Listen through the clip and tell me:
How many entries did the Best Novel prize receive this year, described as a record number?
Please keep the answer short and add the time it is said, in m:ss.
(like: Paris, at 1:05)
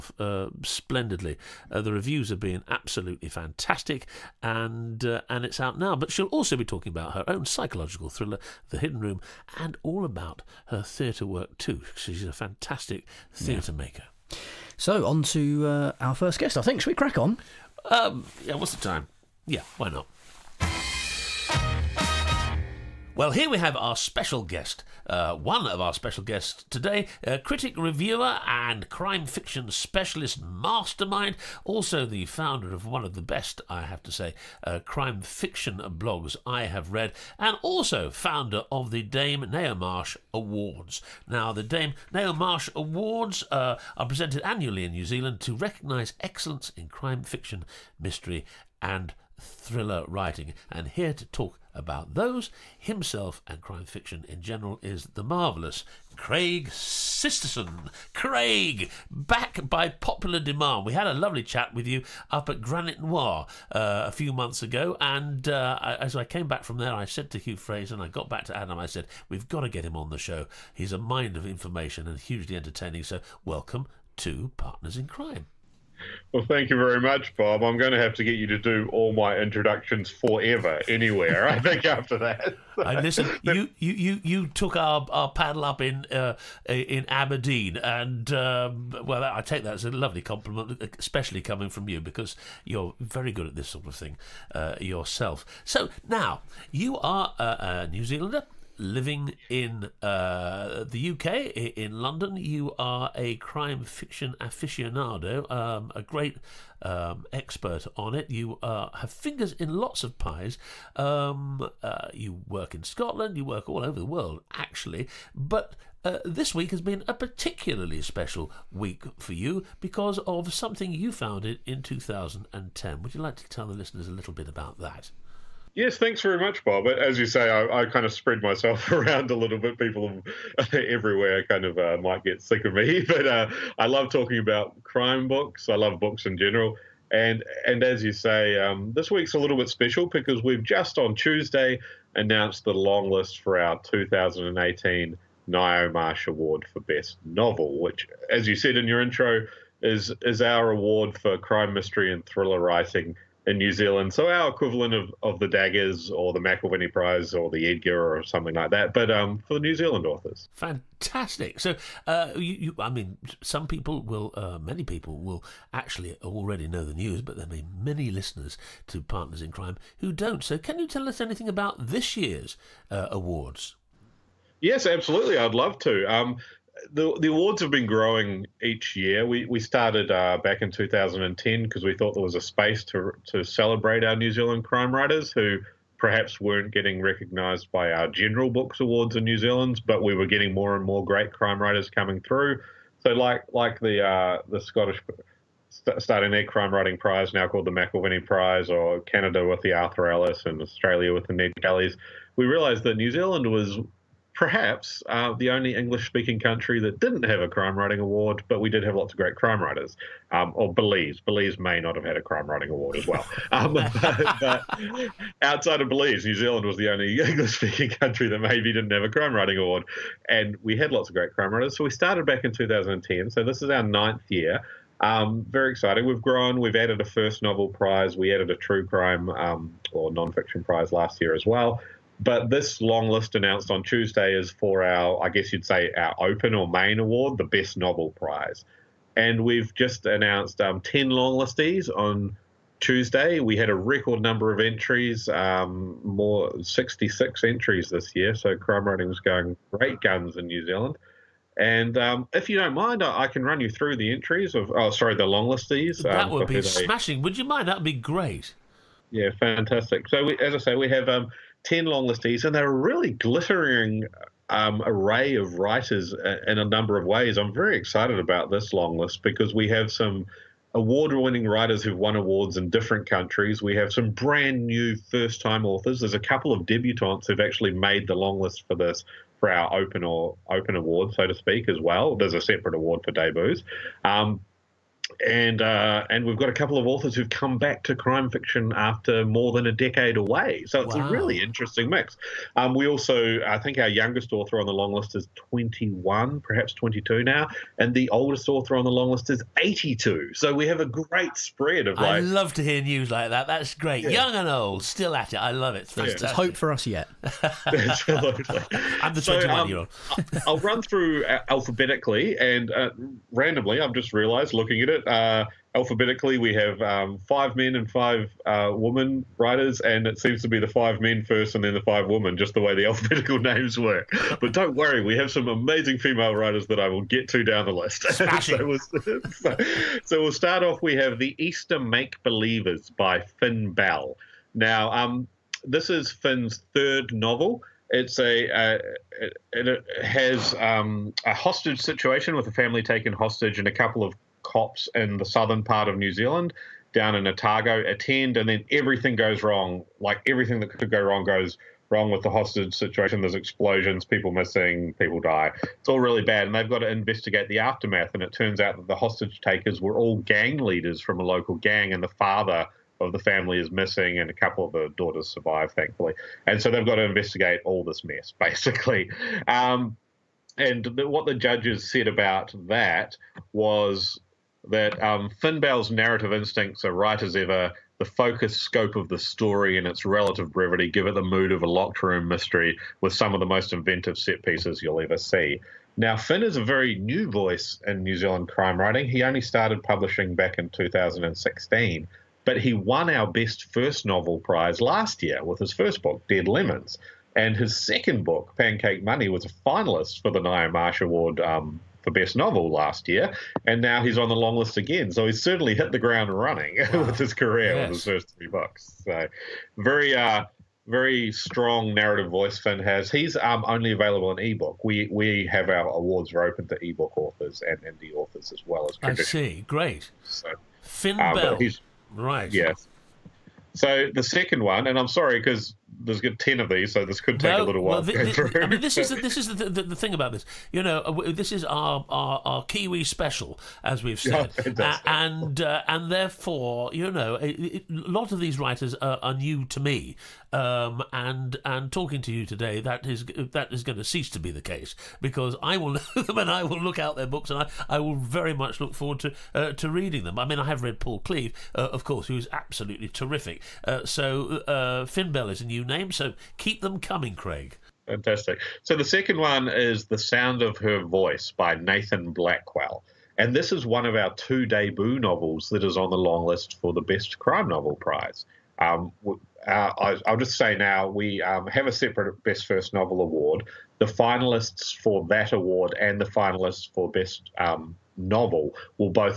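66, at 4:06.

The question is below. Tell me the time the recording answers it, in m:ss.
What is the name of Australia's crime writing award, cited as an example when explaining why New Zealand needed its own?
3:21.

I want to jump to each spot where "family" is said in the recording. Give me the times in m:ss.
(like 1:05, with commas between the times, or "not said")
5:42, 6:03.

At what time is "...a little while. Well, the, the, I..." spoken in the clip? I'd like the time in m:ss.
7:07.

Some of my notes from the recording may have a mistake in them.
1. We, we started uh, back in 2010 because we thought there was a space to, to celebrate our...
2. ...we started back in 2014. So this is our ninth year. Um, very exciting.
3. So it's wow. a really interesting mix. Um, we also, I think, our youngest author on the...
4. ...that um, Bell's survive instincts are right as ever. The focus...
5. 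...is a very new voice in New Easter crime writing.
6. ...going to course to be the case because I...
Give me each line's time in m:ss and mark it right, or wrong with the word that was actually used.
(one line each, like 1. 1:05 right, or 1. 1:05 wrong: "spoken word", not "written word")
1. 2:59 right
2. 3:41 wrong: "2010", not "2014"
3. 4:50 right
4. 6:14 wrong: "narrative", not "survive"
5. 6:26 wrong: "Zealand", not "Easter"
6. 7:23 wrong: "cease", not "course".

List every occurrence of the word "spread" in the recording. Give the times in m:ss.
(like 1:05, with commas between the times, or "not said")
2:08, 5:01.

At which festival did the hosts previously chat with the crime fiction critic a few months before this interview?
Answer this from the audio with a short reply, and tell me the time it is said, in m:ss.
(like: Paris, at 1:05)
Granite Noir, at 1:02.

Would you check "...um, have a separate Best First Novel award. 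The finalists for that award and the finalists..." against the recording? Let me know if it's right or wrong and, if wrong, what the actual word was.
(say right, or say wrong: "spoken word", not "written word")
right.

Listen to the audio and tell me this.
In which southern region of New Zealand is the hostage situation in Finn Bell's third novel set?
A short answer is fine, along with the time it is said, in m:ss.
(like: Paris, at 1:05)
Otago, at 5:47.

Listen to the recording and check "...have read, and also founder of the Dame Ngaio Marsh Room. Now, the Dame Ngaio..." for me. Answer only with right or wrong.
wrong.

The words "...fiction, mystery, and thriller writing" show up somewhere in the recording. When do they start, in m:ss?
0:47.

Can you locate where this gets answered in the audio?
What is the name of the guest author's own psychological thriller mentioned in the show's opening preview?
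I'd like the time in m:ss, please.
0:08.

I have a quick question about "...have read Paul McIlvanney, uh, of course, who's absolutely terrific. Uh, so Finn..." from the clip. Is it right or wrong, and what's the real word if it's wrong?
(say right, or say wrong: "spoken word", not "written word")
wrong: "Cleave", not "McIlvanney".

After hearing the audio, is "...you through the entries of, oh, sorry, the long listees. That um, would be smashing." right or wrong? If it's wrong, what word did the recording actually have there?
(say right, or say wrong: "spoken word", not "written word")
right.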